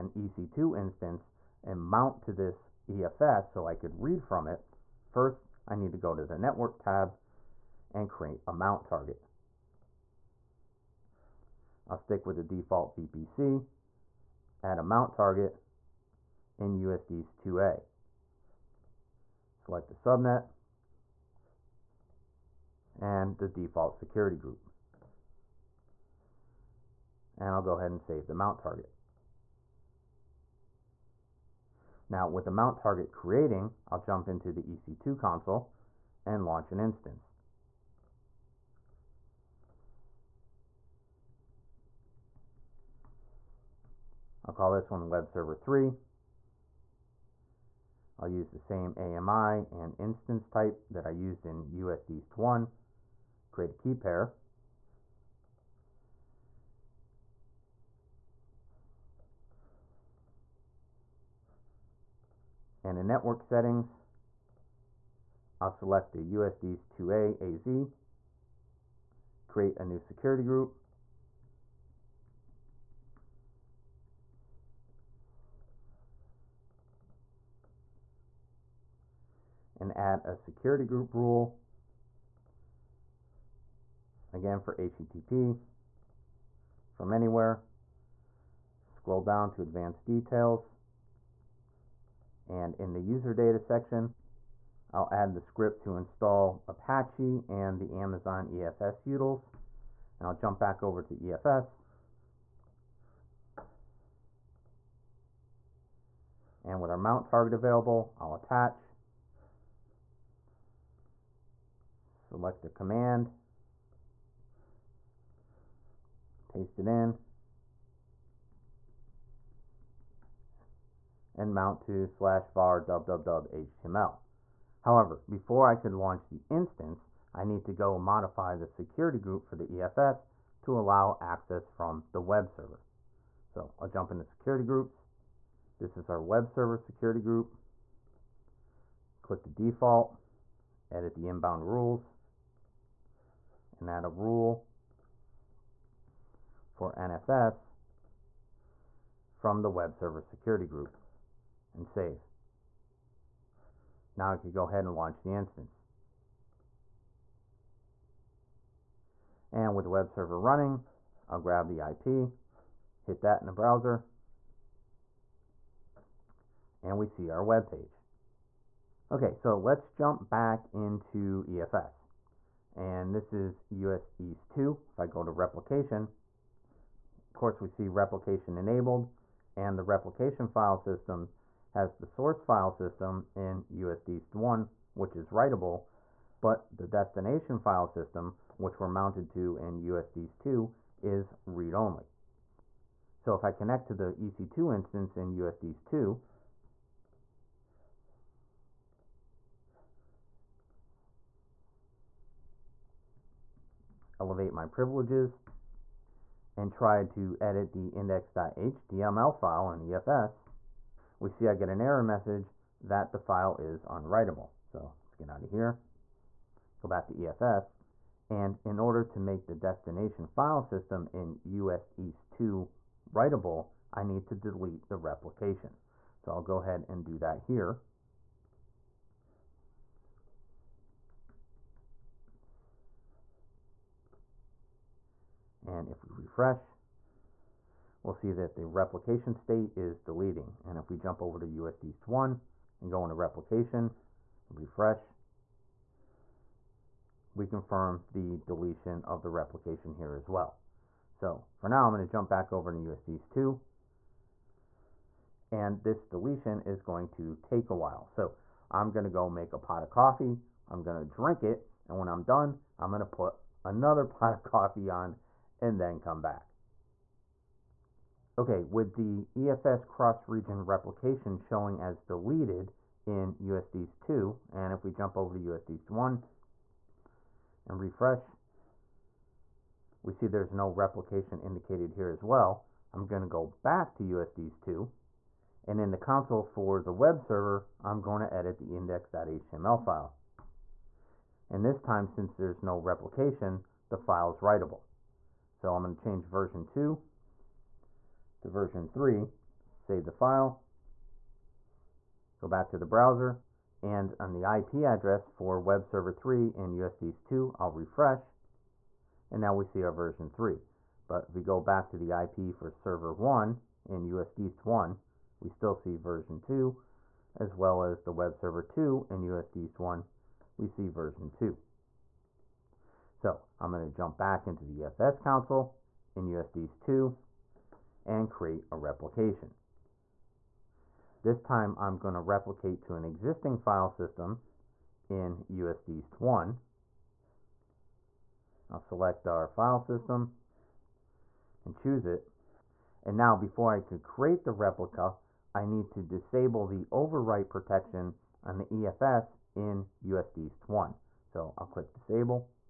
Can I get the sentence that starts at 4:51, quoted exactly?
And this time, since there's no replication, the file is writable.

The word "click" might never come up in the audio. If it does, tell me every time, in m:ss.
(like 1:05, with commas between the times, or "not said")
2:19, 5:51.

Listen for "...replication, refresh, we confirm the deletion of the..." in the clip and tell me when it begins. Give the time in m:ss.
4:03.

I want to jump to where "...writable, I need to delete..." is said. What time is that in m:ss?
3:43.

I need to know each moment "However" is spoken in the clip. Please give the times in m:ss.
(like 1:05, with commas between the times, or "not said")
2:04.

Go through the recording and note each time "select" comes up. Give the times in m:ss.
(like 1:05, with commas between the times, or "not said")
0:19, 1:05, 1:52, 5:38.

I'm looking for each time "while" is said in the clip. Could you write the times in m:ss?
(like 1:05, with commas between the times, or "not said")
4:17.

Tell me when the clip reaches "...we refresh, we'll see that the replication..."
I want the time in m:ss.
3:56.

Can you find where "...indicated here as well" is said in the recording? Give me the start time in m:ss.
4:41.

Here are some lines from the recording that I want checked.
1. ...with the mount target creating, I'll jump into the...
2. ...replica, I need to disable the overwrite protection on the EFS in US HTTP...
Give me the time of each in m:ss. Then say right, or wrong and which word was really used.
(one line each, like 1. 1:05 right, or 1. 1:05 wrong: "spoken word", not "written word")
1. 0:32 right
2. 5:44 wrong: "East", not "HTTP".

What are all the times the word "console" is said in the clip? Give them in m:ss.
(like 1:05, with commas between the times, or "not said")
0:35, 4:45, 5:25.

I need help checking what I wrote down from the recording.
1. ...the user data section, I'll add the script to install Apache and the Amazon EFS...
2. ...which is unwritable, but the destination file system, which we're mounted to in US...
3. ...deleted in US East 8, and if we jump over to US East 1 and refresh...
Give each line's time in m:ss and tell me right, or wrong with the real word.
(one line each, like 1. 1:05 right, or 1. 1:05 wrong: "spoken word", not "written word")
1. 1:32 right
2. 3:04 wrong: "writable", not "unwritable"
3. 4:32 wrong: "2", not "8".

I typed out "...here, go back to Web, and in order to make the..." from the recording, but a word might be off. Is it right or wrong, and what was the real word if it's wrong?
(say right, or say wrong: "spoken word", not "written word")
wrong: "EFS", not "Web".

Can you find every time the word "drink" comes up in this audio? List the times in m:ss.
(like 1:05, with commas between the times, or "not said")
4:21.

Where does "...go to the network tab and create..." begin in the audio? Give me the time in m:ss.
0:05.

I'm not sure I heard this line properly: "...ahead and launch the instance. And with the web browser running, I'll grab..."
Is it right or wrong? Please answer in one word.
wrong.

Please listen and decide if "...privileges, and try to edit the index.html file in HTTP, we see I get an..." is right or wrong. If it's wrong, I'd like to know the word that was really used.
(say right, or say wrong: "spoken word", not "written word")
wrong: "EFS", not "HTTP".